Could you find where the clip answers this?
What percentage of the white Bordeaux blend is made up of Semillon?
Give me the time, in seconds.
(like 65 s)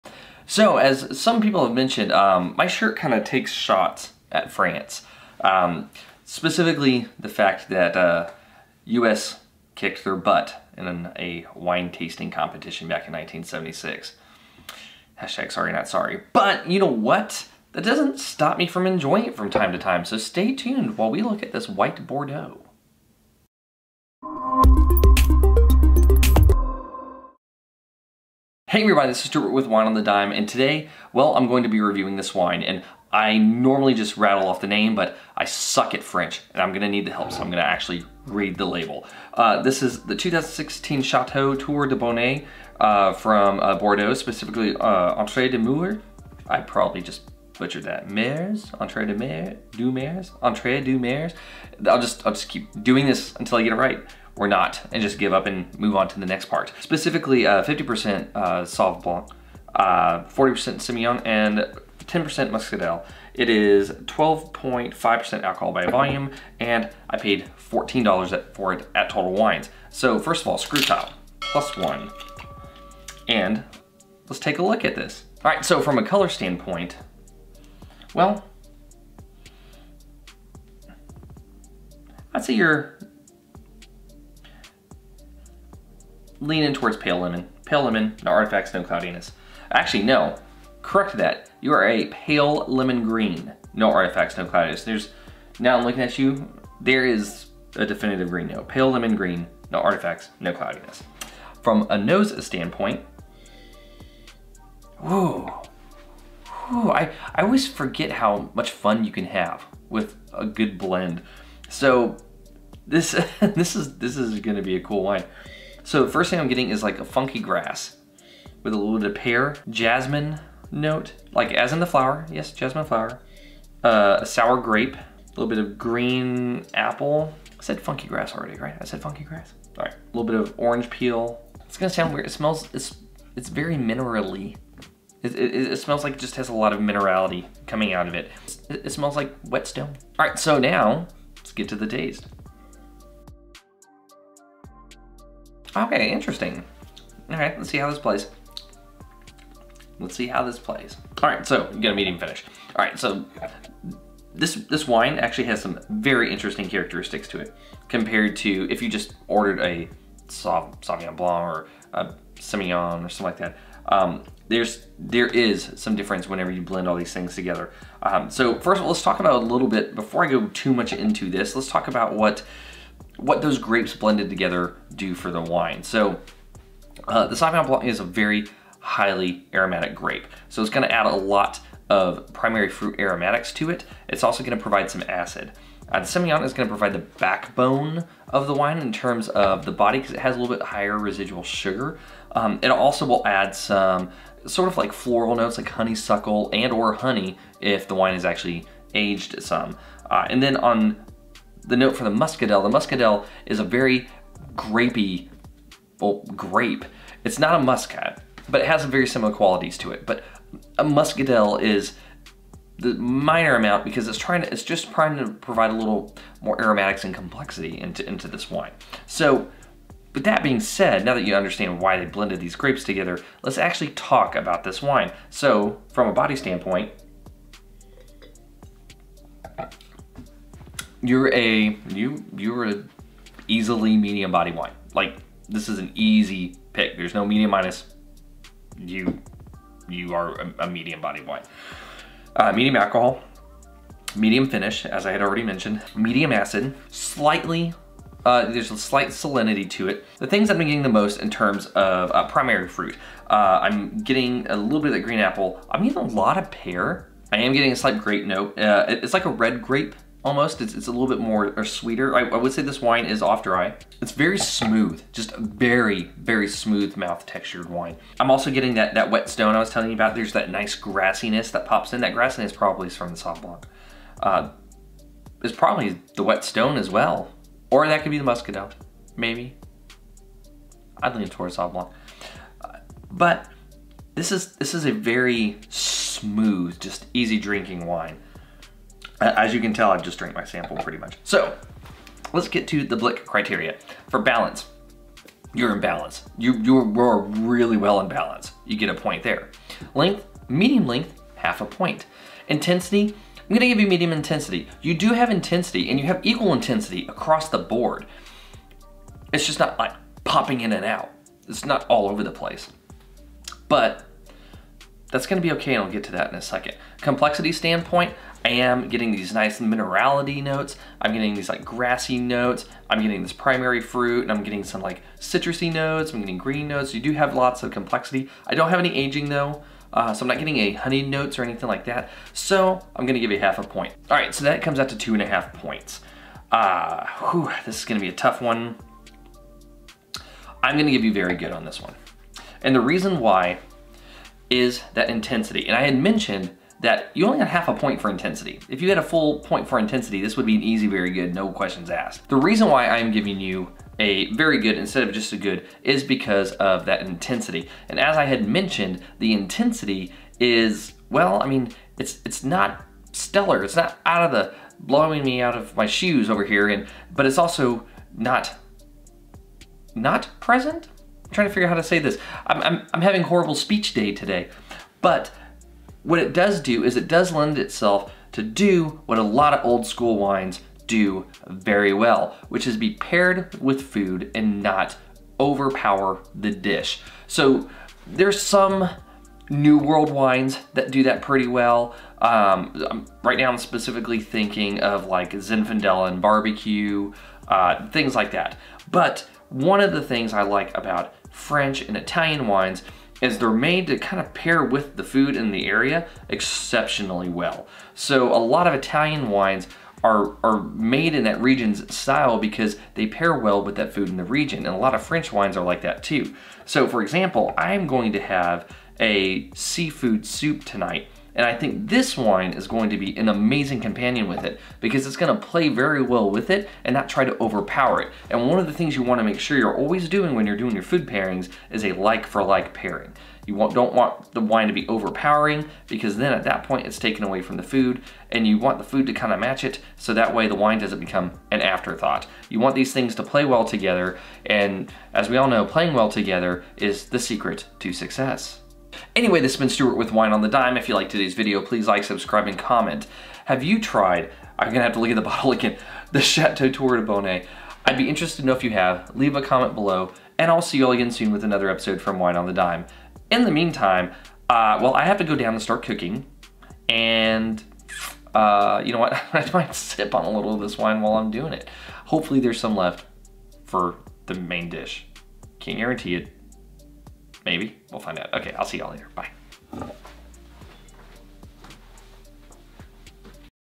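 59 s.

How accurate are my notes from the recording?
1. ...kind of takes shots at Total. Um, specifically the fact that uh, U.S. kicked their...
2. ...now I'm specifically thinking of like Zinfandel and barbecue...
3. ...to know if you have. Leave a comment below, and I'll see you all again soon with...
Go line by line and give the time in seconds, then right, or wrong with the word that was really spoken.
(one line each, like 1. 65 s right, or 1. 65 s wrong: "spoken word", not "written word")
1. 2 s wrong: "France", not "Total"
2. 393 s right
3. 458 s right.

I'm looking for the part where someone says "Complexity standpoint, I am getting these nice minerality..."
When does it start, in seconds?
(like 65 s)
317 s.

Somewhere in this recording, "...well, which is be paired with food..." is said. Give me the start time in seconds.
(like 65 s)
381 s.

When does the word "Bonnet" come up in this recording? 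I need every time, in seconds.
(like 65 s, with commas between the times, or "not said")
41 s, 457 s.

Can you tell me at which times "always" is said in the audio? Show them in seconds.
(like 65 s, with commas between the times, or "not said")
107 s, 429 s.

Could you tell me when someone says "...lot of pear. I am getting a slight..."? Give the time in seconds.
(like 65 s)
256 s.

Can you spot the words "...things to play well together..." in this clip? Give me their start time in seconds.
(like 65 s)
442 s.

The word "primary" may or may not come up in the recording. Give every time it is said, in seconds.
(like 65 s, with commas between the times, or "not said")
182 s, 252 s, 323 s.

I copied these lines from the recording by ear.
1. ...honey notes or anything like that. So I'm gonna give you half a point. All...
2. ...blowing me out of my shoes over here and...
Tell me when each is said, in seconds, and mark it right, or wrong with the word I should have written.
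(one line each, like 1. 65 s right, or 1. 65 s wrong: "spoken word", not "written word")
1. 330 s right
2. 364 s right.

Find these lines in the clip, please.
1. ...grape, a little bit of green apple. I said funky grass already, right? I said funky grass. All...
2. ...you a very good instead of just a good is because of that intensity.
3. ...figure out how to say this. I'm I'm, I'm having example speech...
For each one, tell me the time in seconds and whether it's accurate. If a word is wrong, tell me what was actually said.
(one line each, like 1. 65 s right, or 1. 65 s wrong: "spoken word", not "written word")
1. 124 s right
2. 353 s right
3. 371 s wrong: "horrible", not "example".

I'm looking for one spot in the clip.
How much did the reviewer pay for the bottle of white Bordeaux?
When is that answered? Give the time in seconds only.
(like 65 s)
67 s.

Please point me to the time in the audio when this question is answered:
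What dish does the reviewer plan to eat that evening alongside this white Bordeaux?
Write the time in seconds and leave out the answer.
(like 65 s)
419 s.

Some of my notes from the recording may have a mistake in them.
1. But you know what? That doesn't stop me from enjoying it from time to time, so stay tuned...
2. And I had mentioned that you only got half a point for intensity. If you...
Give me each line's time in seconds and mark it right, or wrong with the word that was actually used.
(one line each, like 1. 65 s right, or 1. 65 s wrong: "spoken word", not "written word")
1. 16 s right
2. 345 s right.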